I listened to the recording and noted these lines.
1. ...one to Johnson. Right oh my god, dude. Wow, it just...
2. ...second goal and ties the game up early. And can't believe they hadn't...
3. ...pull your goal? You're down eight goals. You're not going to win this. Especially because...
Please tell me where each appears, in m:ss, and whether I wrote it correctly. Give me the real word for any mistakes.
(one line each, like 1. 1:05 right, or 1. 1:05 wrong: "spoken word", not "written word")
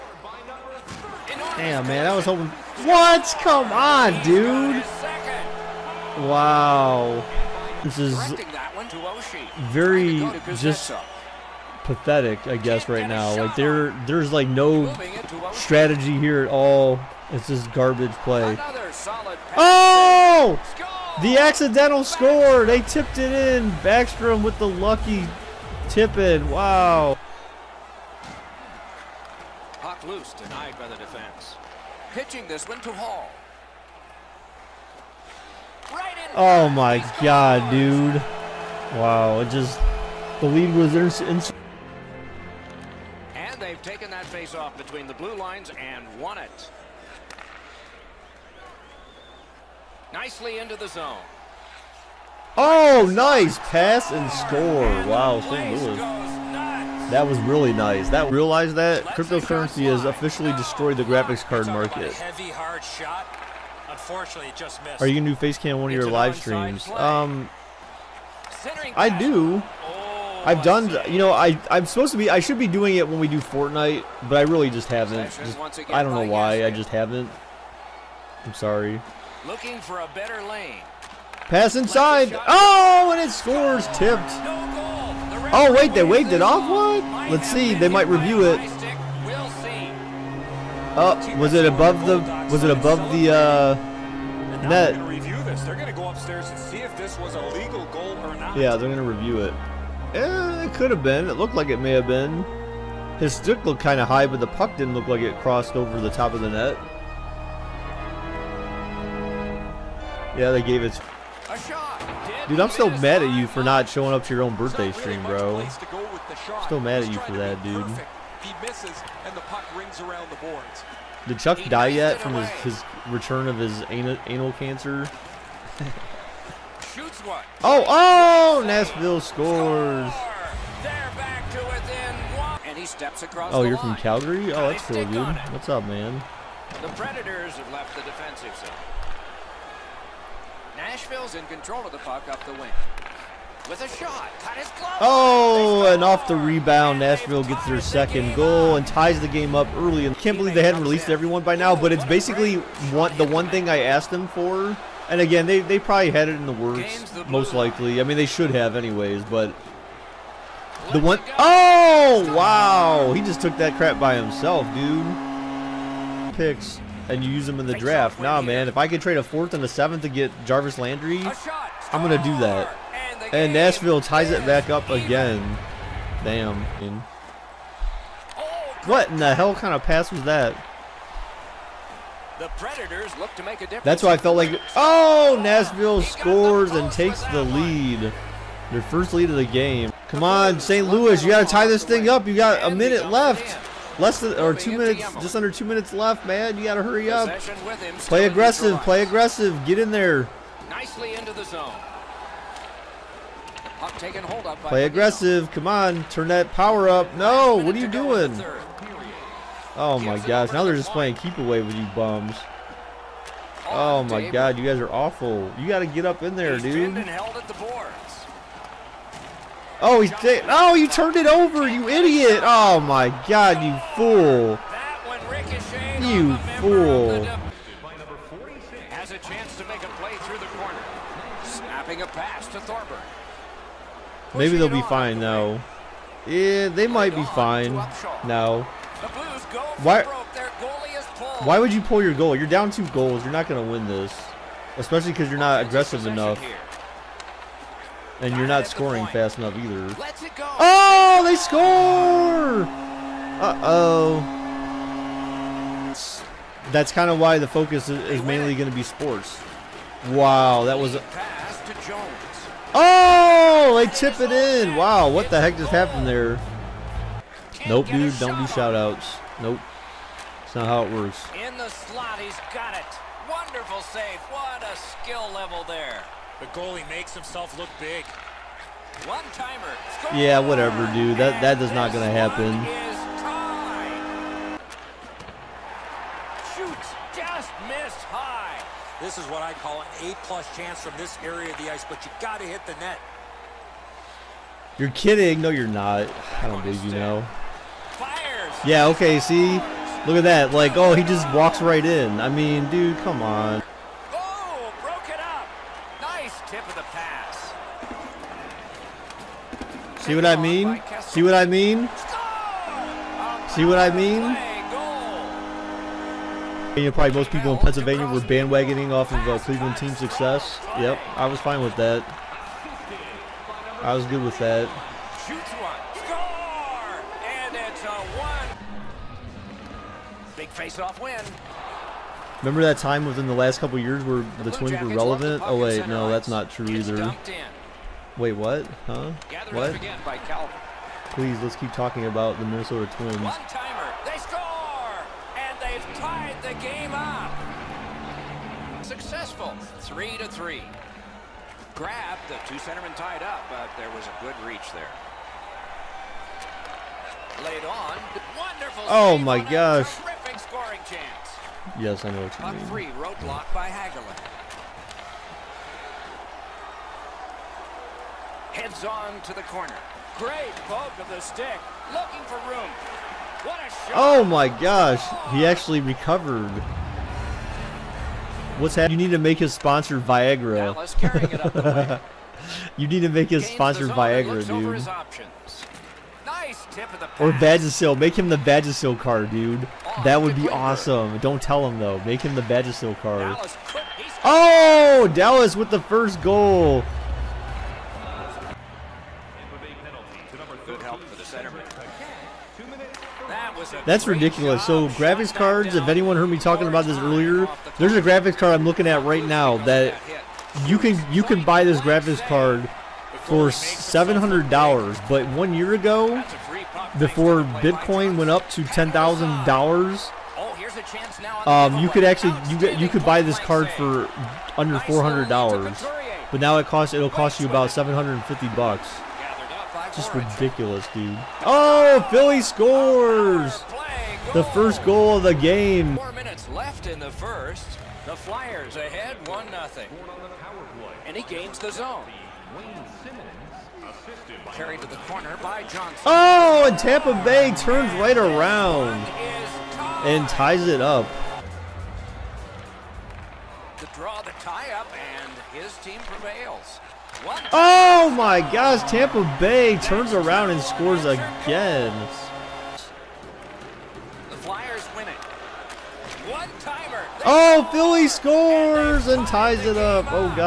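1. 0:32 wrong: "Hall", not "Johnson"
2. 2:27 right
3. 4:01 wrong: "two", not "eight".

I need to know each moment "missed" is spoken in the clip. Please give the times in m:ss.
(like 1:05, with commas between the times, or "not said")
1:04, 4:47.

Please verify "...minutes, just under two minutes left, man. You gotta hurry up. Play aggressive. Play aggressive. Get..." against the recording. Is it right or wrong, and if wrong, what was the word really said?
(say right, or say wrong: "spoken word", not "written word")
right.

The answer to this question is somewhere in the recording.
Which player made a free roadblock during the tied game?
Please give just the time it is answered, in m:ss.
6:03.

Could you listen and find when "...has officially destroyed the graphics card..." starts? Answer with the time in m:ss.
0:59.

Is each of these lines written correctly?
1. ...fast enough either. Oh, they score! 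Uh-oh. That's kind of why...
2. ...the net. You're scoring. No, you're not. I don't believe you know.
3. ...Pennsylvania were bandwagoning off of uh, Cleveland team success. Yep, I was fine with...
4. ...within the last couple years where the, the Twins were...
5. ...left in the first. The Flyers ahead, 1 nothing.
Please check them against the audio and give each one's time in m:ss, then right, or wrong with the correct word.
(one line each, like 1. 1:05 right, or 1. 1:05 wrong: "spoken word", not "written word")
1. 4:09 right
2. 4:52 wrong: "kidding", not "scoring"
3. 5:17 right
4. 5:33 right
5. 7:16 right.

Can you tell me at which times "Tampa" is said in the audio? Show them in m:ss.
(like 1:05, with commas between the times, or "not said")
7:26, 7:38.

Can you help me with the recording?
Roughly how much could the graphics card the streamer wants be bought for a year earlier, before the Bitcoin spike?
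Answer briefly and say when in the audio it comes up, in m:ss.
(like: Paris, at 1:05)
Under $400, at 7:04.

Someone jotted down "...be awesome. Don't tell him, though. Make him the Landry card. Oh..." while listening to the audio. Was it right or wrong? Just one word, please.
wrong.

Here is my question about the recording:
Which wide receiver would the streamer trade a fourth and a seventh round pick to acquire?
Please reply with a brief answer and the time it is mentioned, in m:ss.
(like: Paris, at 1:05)
Jarvis Landry, at 2:50.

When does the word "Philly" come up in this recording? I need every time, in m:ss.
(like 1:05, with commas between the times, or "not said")
7:12, 7:47.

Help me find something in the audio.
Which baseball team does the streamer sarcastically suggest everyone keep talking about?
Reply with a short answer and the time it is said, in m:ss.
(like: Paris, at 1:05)
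Minnesota Twins, at 5:42.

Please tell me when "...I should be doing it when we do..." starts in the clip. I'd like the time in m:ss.
1:12.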